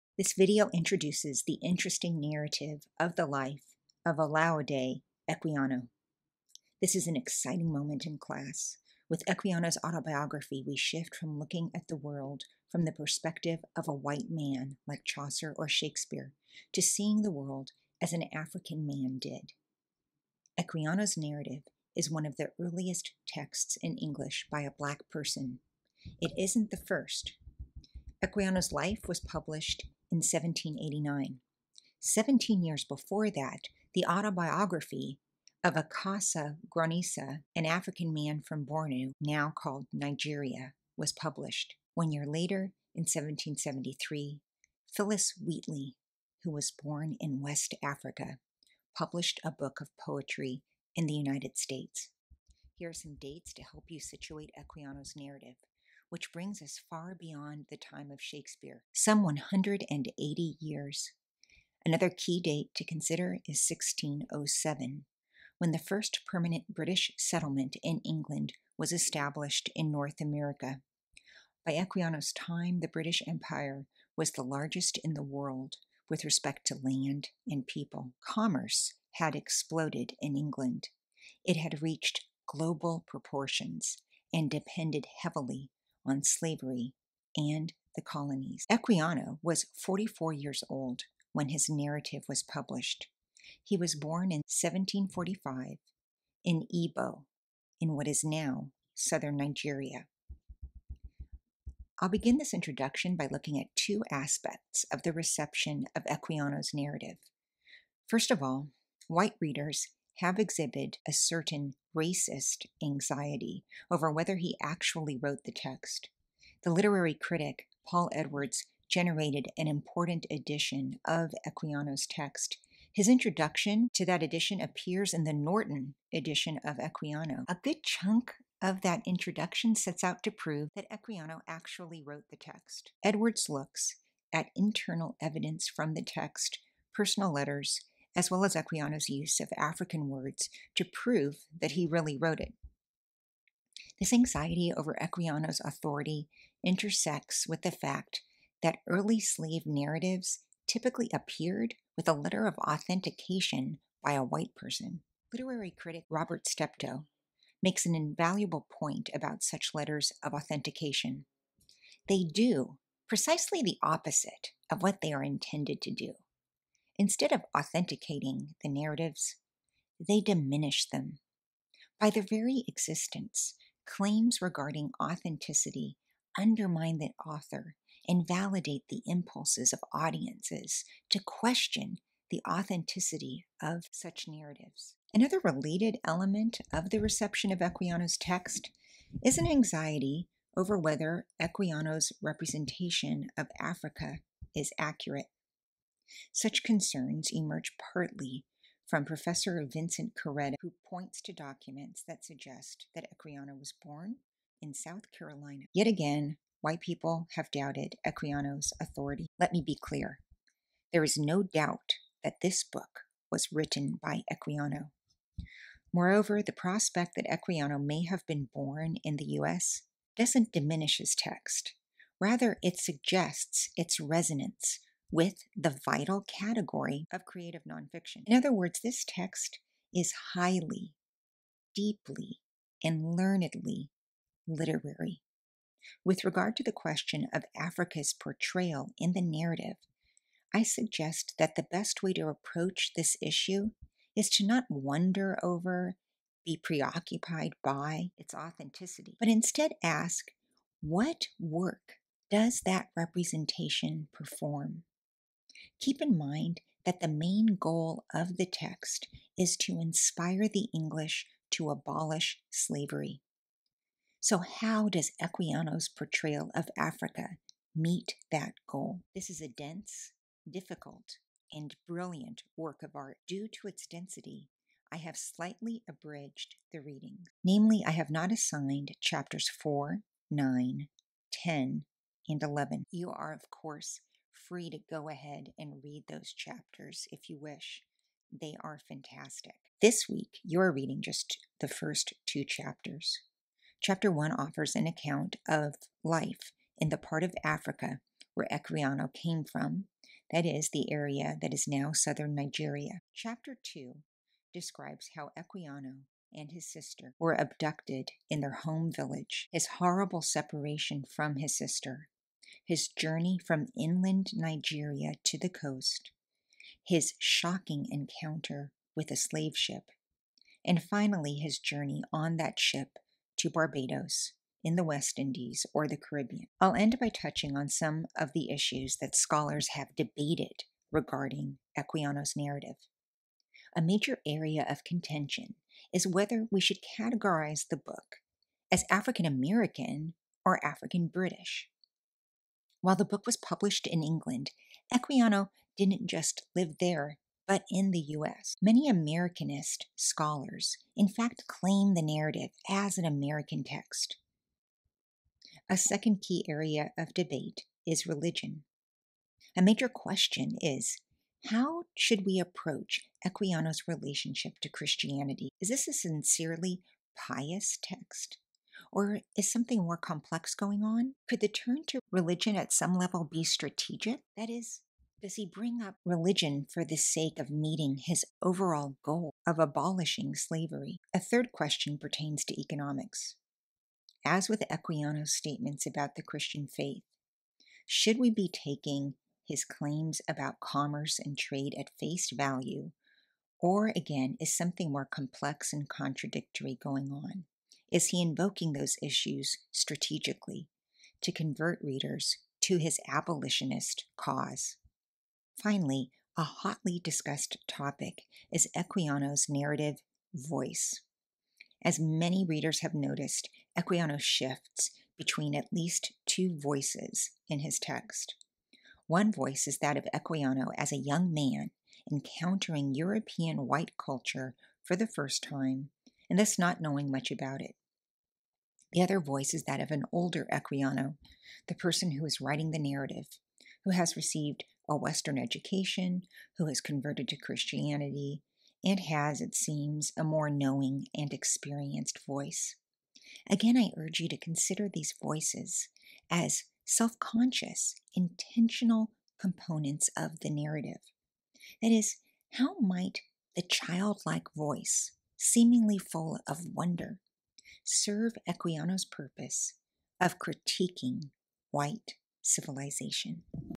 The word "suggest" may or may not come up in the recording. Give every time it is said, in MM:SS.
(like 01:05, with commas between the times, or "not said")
03:22, 03:42, 04:00.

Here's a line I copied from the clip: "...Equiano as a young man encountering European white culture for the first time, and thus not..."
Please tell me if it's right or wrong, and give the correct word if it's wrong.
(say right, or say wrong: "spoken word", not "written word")
right.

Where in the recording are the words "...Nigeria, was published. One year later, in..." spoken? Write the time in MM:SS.
00:39.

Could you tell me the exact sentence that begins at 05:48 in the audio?
Many Americanist scholars, in fact, claim the narrative as an American text.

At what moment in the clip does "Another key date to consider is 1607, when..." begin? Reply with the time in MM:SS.
01:01.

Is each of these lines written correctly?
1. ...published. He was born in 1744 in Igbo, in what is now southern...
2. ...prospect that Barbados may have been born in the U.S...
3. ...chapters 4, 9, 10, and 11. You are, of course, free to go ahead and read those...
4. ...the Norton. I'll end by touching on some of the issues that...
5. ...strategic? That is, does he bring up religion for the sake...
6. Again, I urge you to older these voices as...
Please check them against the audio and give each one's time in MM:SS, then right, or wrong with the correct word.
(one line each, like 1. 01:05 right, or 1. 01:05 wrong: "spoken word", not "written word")
1. 01:32 wrong: "1745", not "1744"
2. 03:36 wrong: "Equiano", not "Barbados"
3. 04:38 right
4. 05:25 wrong: "Caribbean", not "Norton"
5. 06:13 right
6. 07:23 wrong: "consider", not "older".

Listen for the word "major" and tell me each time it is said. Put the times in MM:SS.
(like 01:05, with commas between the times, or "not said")
05:33, 05:59.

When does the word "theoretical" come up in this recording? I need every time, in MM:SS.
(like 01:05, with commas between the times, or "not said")
not said.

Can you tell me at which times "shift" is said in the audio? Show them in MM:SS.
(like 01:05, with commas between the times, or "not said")
00:10, 06:54.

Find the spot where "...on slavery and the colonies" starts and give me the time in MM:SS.
01:26.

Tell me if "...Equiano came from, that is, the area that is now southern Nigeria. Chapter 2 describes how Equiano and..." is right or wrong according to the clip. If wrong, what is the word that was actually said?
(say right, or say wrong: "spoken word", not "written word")
right.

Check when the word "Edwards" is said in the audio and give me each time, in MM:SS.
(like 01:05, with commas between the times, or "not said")
01:58, 02:13.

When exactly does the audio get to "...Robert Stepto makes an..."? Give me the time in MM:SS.
02:36.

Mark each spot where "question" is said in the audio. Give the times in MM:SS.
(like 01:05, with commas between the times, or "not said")
03:01, 03:56, 05:59, 06:21.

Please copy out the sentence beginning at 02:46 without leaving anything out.
Instead of authenticating the narratives, they diminish them.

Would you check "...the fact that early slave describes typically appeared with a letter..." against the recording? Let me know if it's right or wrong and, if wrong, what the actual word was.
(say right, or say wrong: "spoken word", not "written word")
wrong: "narratives", not "describes".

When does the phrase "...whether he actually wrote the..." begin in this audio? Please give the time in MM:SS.
01:54.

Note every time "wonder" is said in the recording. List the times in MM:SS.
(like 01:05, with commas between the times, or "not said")
04:04, 07:36.